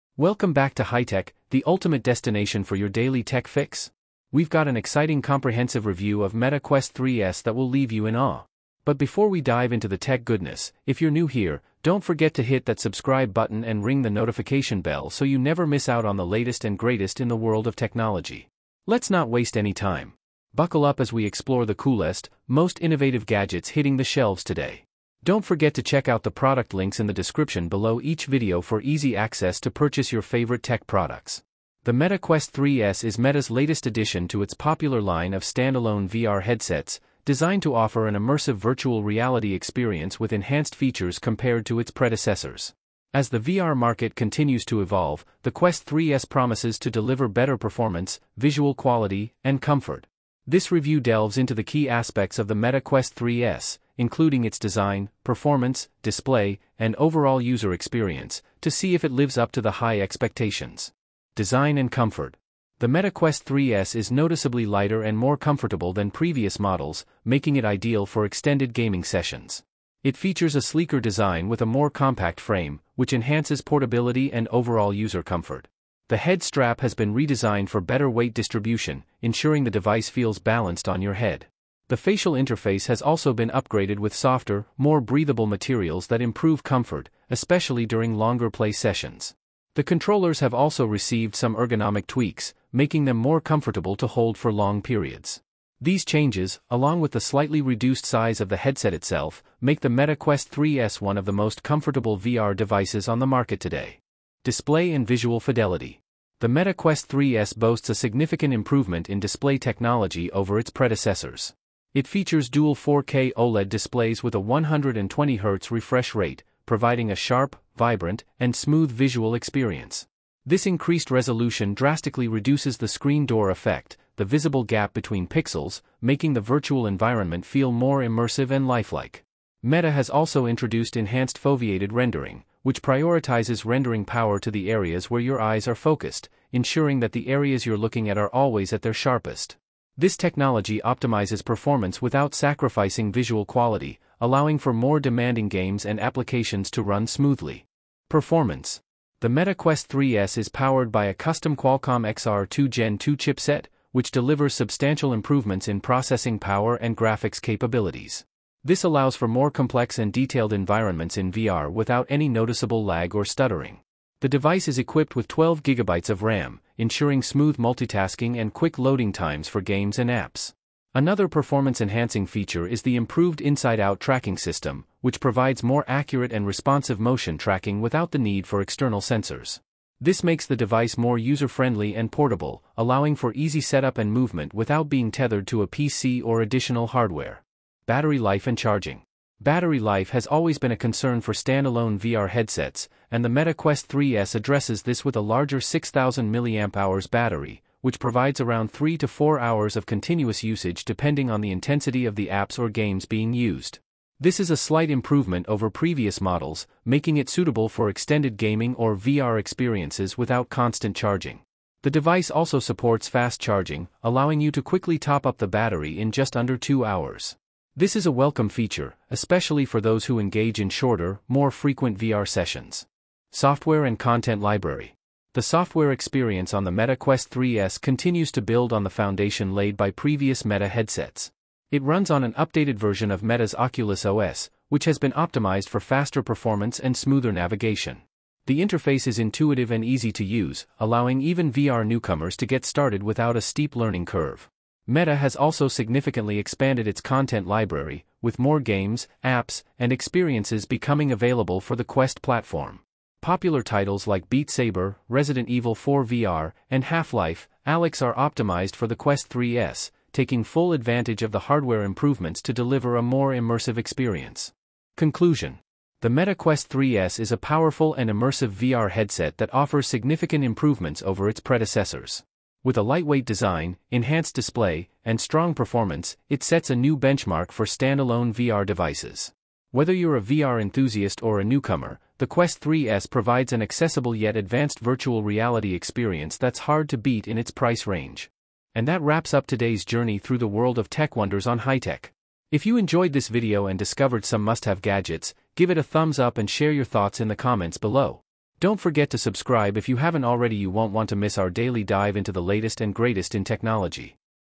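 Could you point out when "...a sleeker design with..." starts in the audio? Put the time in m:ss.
1:10.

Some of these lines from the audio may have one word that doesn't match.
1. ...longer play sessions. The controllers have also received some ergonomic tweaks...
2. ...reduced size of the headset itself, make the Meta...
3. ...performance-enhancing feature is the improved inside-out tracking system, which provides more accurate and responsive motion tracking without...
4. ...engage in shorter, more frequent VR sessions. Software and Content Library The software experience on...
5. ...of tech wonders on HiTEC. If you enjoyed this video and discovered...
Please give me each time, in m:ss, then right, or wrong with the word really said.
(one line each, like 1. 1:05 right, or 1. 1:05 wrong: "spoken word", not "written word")
1. 1:28 right
2. 1:37 right
3. 2:51 right
4. 3:40 right
5. 4:50 right.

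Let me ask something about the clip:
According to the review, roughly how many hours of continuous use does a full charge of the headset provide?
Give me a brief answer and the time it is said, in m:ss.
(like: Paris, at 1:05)
3 to 4 hours, at 3:18.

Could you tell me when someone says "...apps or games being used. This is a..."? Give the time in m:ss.
3:22.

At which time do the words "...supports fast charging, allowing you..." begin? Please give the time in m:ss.
3:32.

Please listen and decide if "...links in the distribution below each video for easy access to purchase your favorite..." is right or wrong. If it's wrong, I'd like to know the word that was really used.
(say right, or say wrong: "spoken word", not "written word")
wrong: "description", not "distribution".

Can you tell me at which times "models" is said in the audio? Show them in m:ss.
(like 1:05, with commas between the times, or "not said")
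1:06, 3:26.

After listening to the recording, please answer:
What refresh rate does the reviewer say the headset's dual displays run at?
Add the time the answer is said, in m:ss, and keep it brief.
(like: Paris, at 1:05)
120Hz, at 1:54.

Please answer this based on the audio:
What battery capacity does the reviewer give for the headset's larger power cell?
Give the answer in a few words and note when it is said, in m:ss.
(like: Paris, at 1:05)
6000 mAh, at 3:15.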